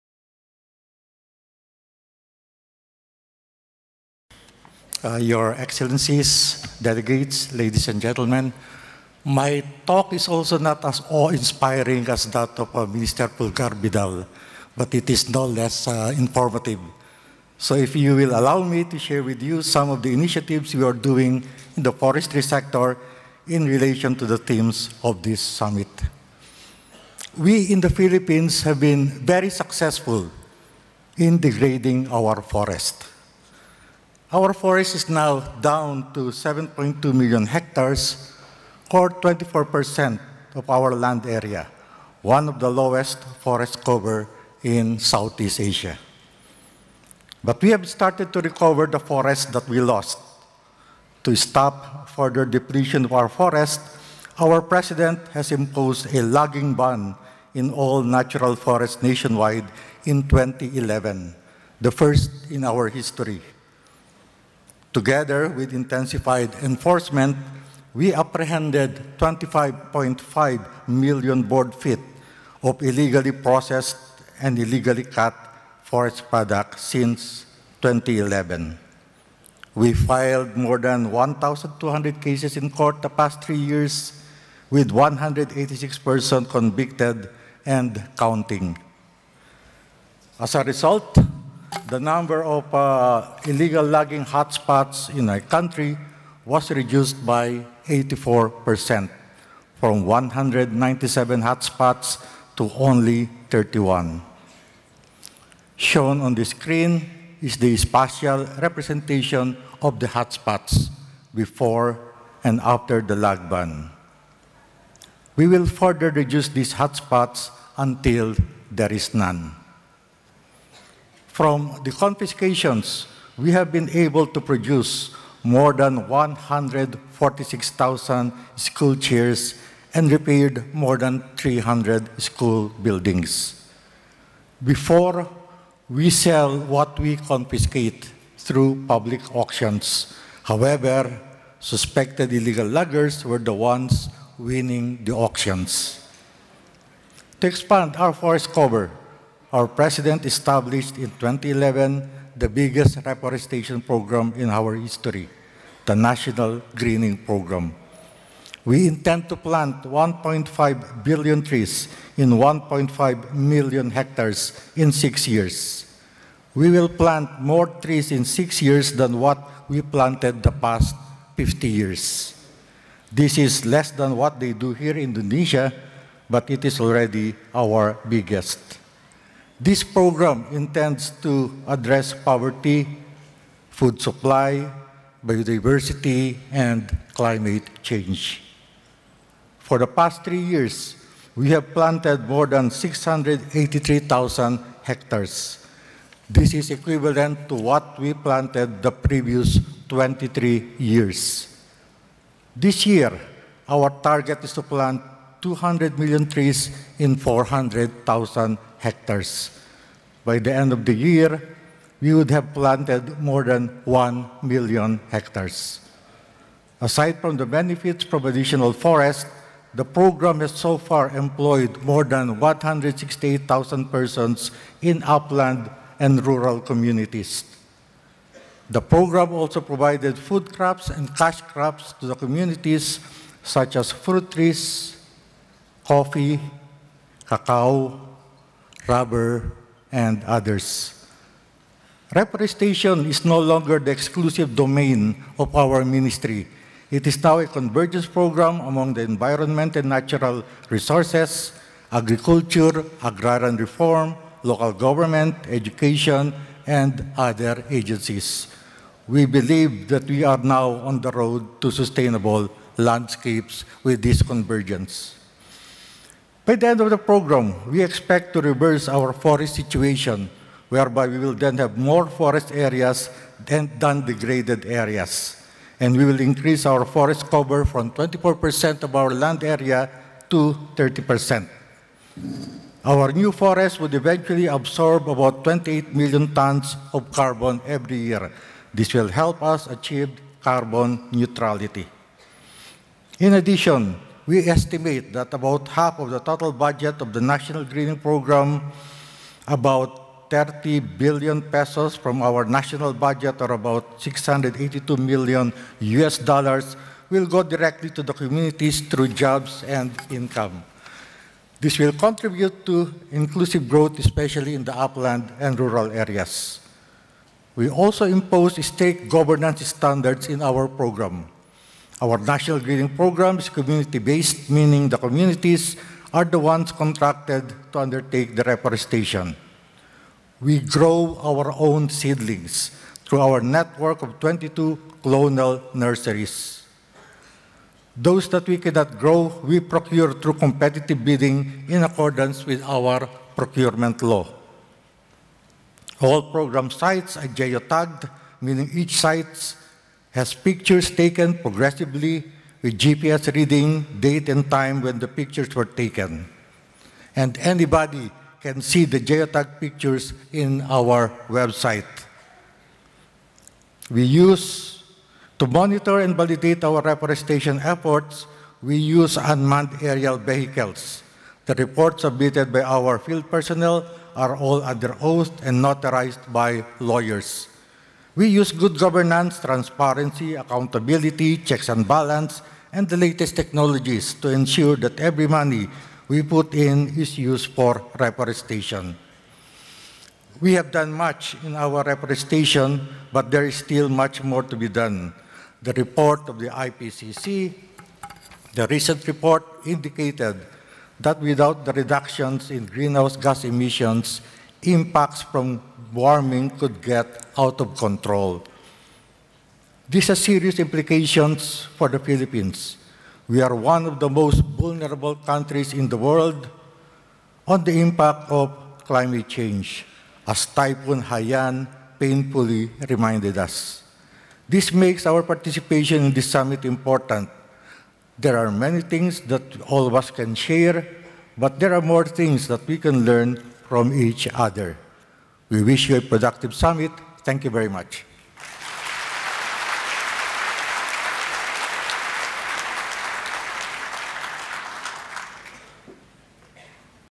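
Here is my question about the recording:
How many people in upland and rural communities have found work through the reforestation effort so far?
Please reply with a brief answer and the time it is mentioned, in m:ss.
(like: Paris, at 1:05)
168,000, at 3:42.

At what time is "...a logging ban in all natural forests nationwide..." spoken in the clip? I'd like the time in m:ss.
0:56.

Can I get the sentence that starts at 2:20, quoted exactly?
However, suspected illegal loggers were the ones winning the auctions.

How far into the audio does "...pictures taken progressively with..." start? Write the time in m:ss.
5:50.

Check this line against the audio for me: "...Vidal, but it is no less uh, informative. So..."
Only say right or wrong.
right.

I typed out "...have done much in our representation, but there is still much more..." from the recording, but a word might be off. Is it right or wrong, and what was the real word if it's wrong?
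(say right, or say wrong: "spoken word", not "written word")
wrong: "reforestation", not "representation".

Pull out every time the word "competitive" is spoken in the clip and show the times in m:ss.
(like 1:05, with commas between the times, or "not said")
5:40.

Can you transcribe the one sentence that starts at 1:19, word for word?
We filed more than 1,200 cases in court the past three years, with 186 persons convicted and counting.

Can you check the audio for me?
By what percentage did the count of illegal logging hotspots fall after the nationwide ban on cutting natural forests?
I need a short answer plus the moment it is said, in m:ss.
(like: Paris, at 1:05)
84%, at 1:37.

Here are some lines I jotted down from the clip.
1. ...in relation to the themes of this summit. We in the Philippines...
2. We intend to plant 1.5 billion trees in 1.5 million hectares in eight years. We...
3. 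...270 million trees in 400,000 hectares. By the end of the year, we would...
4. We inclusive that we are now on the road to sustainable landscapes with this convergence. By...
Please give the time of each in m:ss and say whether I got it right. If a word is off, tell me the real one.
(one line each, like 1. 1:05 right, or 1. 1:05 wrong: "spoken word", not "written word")
1. 0:23 right
2. 2:38 wrong: "six", not "eight"
3. 3:25 wrong: "200", not "270"
4. 4:19 wrong: "believe", not "inclusive".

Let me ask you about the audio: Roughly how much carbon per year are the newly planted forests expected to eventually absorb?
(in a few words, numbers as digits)
28 million tons.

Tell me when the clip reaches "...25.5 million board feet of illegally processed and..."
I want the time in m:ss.
1:09.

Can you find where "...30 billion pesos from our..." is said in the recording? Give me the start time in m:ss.
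5:00.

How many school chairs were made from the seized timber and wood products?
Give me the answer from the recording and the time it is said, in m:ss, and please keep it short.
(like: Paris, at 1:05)
146,000, at 2:06.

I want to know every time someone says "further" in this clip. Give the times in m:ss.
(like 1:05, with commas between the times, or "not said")
0:52, 1:55.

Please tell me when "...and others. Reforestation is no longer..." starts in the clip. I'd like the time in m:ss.
3:59.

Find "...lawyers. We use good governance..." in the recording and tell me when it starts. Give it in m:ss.
6:16.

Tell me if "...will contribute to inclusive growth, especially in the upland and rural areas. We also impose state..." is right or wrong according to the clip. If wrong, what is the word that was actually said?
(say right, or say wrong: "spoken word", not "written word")
right.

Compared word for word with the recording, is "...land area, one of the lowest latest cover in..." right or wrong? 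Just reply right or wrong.
wrong.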